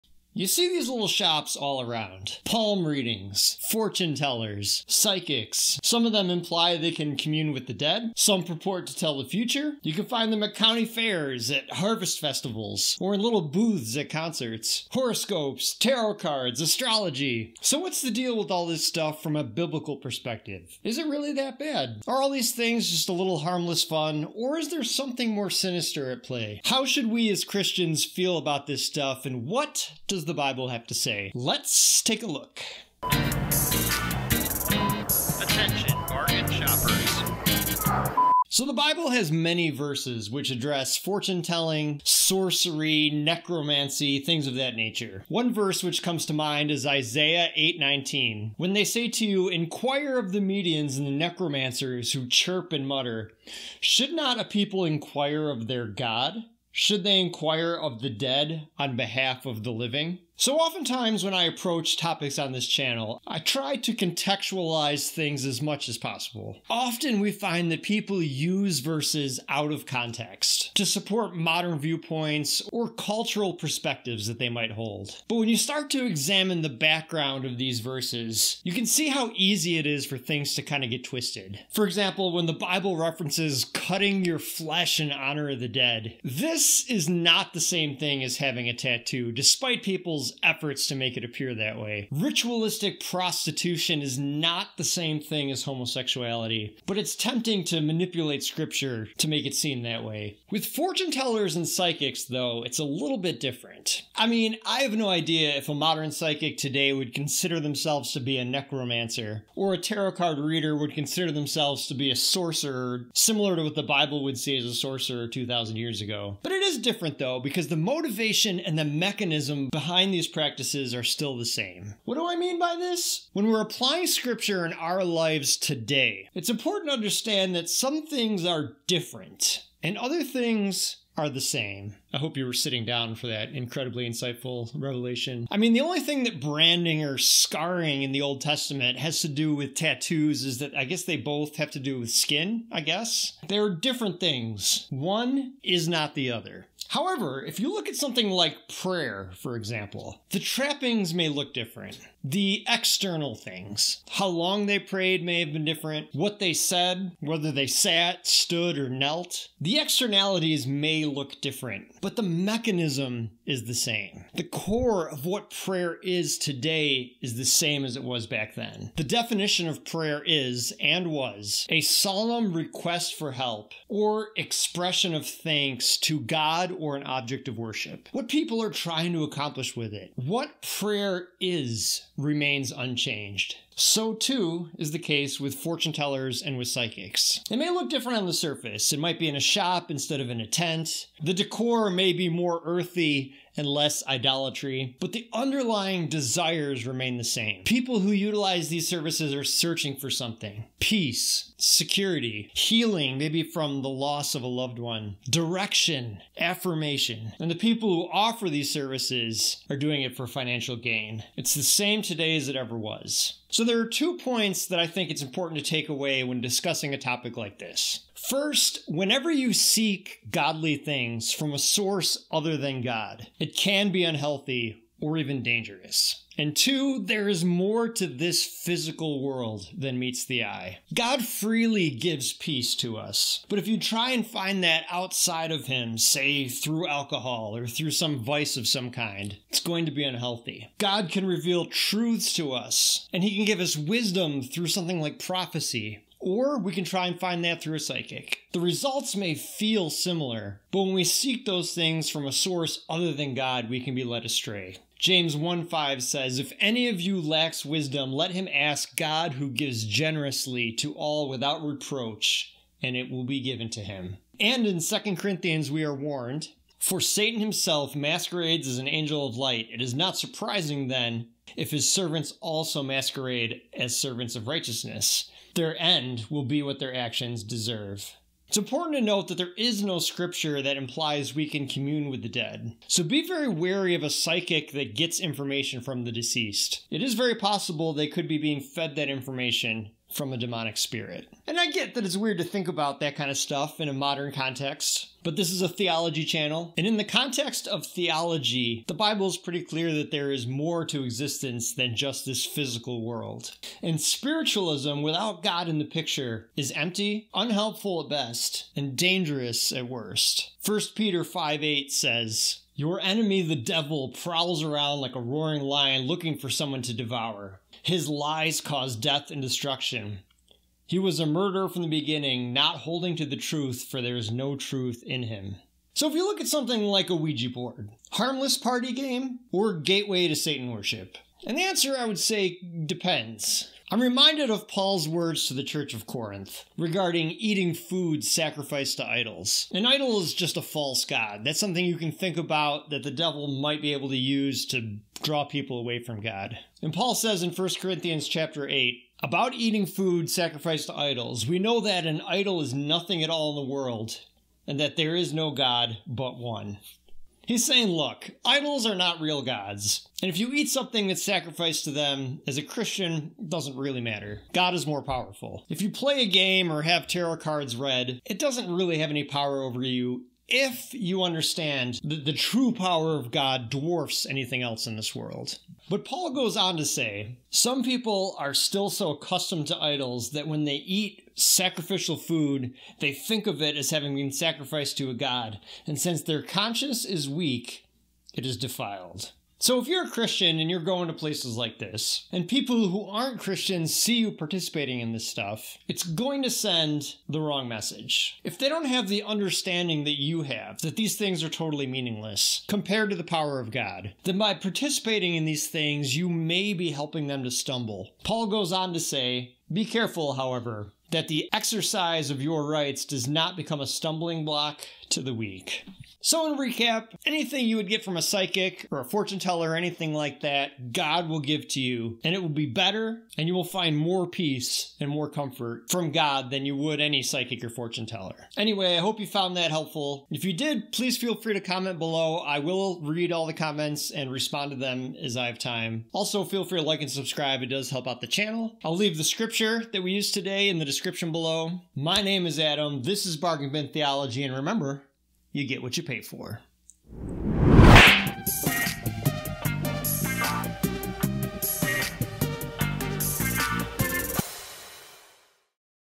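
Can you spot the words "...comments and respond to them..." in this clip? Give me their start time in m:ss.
7:13.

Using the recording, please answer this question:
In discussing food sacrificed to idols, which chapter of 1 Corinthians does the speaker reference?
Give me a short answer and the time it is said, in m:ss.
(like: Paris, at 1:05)
Chapter 8, at 5:48.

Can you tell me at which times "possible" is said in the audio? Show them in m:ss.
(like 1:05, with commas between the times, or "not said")
1:05, 4:47.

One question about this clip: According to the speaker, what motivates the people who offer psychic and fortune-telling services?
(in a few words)
Financial gain.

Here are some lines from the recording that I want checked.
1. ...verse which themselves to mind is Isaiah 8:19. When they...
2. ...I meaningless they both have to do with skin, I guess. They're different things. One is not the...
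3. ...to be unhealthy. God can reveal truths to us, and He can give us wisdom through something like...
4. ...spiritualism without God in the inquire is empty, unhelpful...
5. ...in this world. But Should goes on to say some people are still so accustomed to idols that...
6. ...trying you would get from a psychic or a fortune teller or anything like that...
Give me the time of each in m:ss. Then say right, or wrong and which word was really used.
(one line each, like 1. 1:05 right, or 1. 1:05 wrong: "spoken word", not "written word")
1. 0:45 wrong: "comes", not "themselves"
2. 2:20 wrong: "guess", not "meaningless"
3. 3:59 right
4. 5:04 wrong: "picture", not "inquire"
5. 6:14 wrong: "Paul", not "Should"
6. 6:57 wrong: "anything", not "trying".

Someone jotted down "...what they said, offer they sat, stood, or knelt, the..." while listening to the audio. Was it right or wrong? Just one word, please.
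wrong.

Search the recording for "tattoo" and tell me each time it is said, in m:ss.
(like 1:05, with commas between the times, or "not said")
1:28, 2:19.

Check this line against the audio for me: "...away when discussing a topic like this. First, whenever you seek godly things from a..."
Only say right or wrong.
right.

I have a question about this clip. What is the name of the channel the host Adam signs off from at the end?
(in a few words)
Bargain Bin Theology.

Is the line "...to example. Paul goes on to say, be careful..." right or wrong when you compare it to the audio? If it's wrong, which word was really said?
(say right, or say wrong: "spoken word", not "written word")
wrong: "stumble", not "example".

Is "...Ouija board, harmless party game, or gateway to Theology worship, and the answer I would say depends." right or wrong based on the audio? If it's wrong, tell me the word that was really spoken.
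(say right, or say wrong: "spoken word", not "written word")
wrong: "Satan", not "Theology".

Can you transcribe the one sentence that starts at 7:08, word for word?
Anyway, I hope you found that helpful.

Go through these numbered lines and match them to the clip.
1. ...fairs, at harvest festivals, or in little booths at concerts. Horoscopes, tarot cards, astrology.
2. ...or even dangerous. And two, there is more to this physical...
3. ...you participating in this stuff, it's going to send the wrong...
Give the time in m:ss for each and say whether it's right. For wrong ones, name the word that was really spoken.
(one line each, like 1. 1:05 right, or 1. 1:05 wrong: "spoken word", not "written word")
1. 0:10 right
2. 3:45 right
3. 6:34 right.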